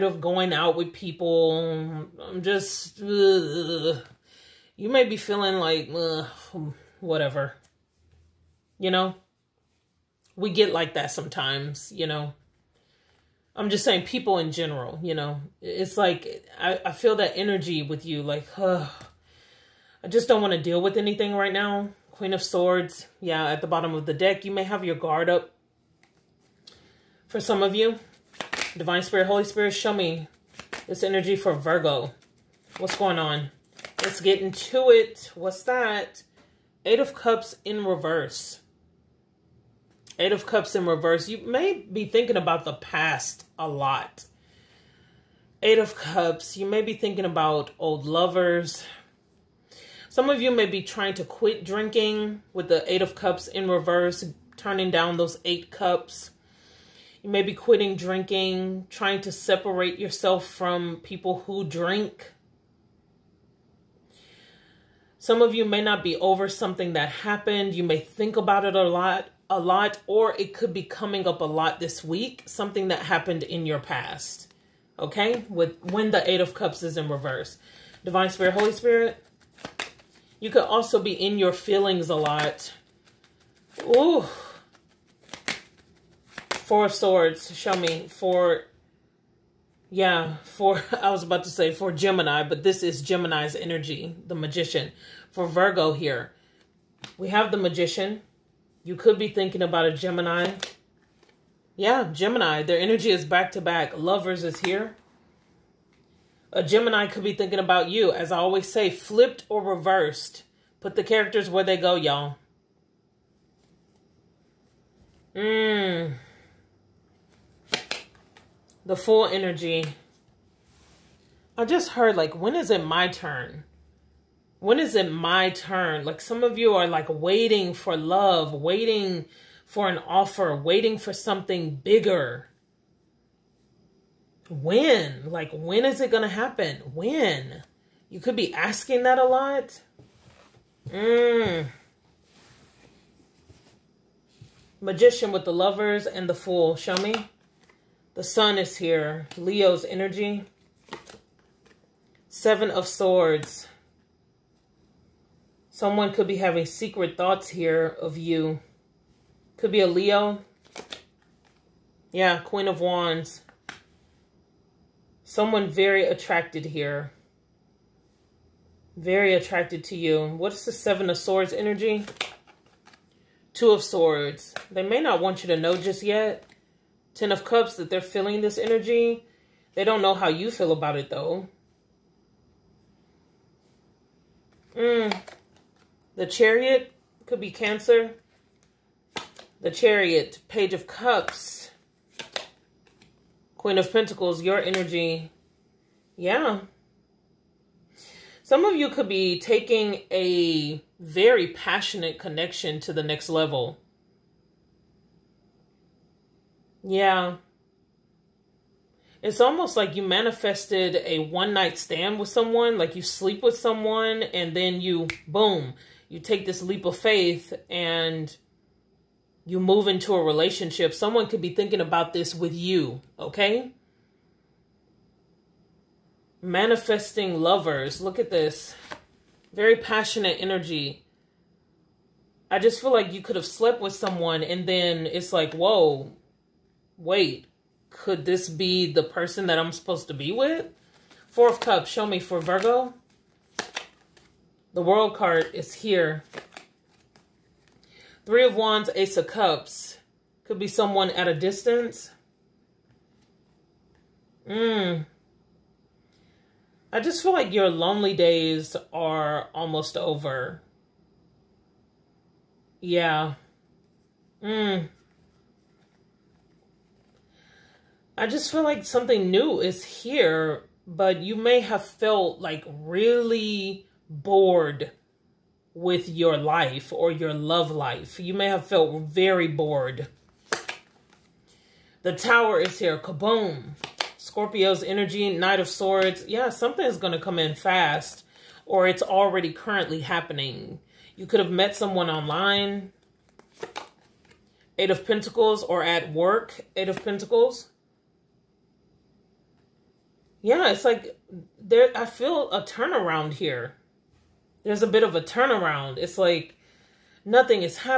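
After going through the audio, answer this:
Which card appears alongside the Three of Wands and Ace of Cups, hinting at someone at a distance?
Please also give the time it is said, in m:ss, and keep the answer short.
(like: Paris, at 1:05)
The World, at 4:04.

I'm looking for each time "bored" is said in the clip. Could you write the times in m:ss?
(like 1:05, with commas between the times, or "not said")
4:34, 4:39.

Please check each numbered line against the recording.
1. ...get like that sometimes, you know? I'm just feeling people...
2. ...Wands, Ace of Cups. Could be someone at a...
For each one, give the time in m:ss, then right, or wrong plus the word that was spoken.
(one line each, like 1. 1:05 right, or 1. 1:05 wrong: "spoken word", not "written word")
1. 0:10 wrong: "saying", not "feeling"
2. 4:08 right.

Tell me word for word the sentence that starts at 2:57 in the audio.
Ten of Cups, that they're feeling this energy.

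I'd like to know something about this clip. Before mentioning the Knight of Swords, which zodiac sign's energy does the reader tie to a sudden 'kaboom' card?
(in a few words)
Scorpio.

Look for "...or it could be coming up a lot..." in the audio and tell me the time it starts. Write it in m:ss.
1:10.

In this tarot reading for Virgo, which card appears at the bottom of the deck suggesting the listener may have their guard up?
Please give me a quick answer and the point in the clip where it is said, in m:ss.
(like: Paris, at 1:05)
Queen of Swords, at 0:22.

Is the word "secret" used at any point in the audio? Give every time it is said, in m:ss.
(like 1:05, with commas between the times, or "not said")
2:36.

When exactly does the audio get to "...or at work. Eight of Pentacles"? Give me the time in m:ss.
4:55.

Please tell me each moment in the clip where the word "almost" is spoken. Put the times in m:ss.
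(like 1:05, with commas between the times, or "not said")
3:29, 4:19.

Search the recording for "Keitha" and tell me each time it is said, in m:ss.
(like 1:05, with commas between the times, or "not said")
not said.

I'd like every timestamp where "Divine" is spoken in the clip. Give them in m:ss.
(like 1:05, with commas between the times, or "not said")
0:28, 1:18.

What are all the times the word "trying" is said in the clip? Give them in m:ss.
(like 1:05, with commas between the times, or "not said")
0:50, 0:58.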